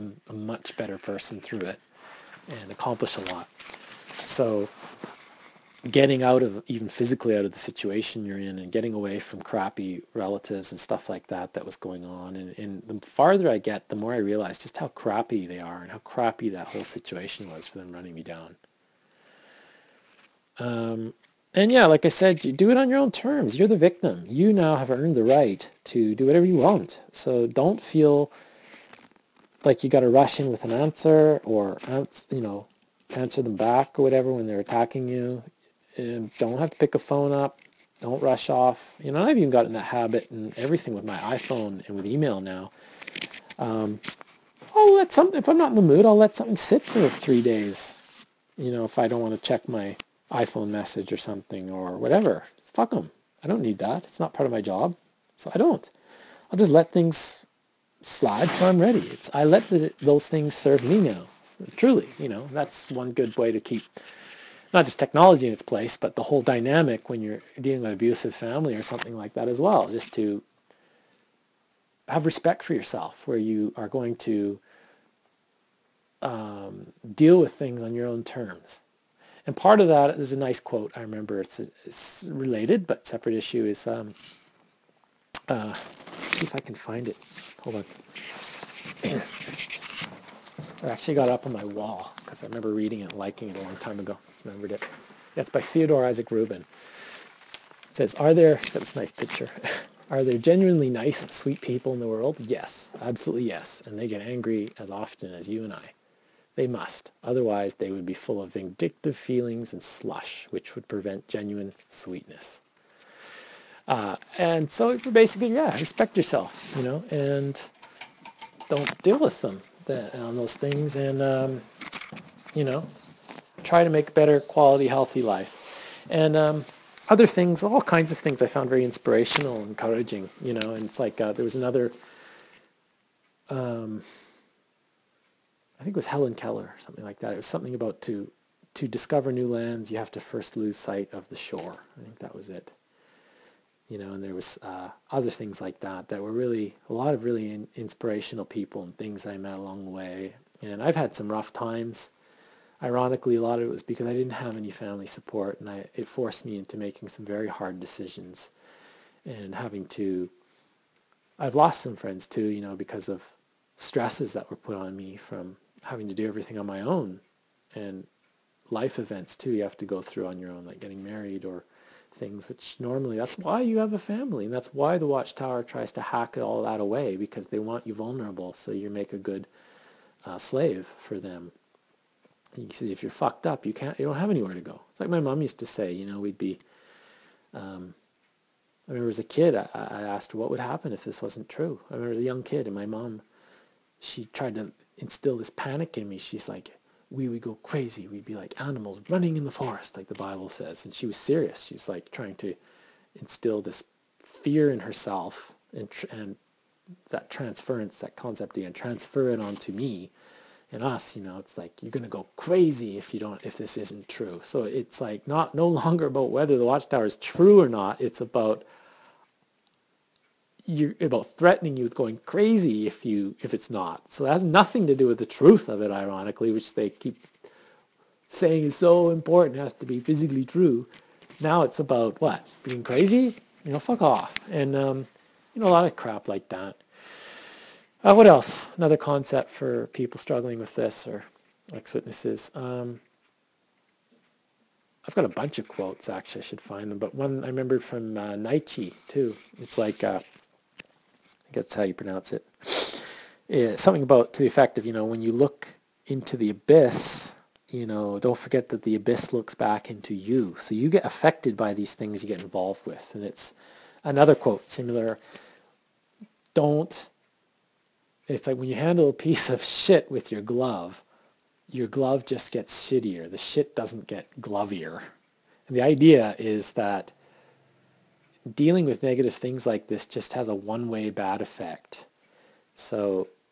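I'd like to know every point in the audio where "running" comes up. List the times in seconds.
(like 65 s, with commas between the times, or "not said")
17 s, 199 s.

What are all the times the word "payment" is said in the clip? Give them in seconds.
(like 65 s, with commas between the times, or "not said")
not said.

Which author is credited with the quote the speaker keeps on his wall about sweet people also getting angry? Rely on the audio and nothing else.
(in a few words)
Theodore Isaac Rubin.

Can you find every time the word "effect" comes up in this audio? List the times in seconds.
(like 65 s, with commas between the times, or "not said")
254 s, 281 s.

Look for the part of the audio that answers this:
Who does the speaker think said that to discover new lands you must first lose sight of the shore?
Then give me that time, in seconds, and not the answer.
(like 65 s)
136 s.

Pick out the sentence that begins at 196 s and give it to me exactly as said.
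She's like, we would go crazy.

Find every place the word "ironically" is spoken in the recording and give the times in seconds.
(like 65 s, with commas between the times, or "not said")
152 s, 225 s.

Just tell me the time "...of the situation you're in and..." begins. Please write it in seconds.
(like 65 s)
7 s.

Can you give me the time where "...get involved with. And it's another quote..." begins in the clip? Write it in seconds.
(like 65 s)
262 s.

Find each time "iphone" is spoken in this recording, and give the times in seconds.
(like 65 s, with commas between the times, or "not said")
41 s, 50 s.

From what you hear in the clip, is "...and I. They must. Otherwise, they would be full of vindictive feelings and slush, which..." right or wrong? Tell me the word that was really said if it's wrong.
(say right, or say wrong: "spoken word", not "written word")
right.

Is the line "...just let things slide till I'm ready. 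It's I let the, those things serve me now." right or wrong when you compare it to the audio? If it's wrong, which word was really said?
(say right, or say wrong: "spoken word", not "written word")
right.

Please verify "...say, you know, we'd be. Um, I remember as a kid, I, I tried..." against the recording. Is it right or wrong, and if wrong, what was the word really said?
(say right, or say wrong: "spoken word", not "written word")
wrong: "asked", not "tried".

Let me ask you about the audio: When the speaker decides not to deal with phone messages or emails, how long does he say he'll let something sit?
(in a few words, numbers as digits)
3 days.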